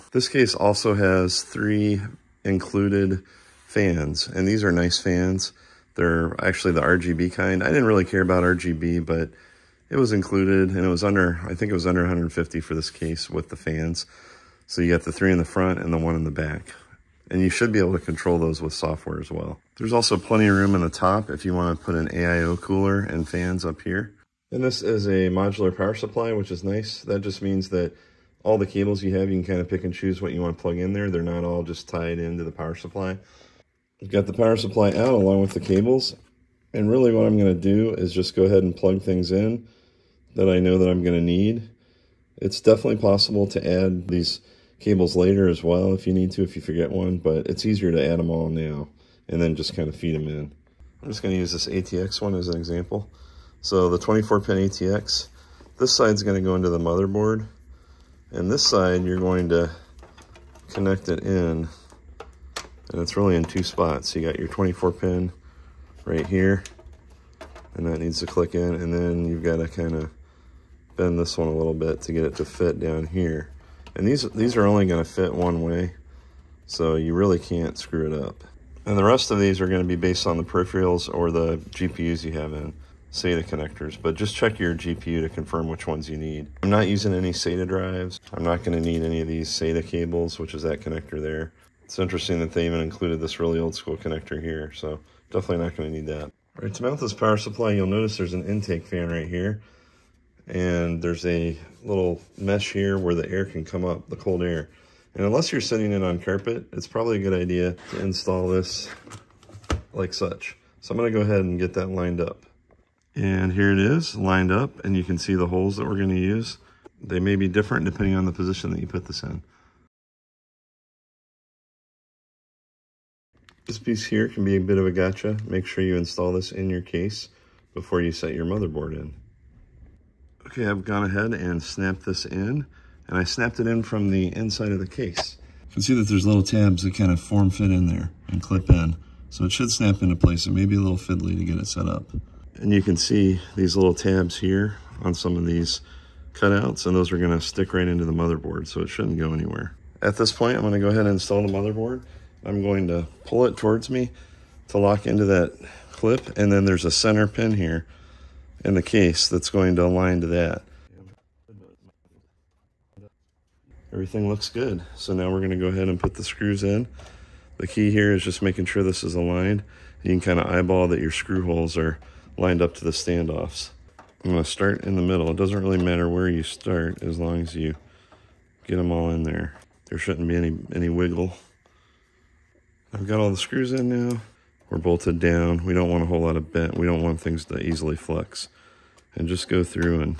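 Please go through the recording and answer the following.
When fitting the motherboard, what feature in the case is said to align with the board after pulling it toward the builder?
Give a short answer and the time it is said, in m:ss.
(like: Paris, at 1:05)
a center pin, at 2:36.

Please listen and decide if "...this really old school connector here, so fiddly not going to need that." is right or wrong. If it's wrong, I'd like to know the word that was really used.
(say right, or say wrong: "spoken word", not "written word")
wrong: "definitely", not "fiddly".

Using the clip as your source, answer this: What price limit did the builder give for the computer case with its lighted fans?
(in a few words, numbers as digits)
under 150.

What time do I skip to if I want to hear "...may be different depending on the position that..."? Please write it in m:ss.
1:57.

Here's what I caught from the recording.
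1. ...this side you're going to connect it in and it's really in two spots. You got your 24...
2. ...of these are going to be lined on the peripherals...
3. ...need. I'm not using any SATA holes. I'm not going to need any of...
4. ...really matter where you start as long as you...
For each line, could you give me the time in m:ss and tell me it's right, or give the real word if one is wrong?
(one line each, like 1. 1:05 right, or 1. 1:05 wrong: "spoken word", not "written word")
1. 0:58 right
2. 1:19 wrong: "based", not "lined"
3. 1:26 wrong: "drives", not "holes"
4. 2:55 right.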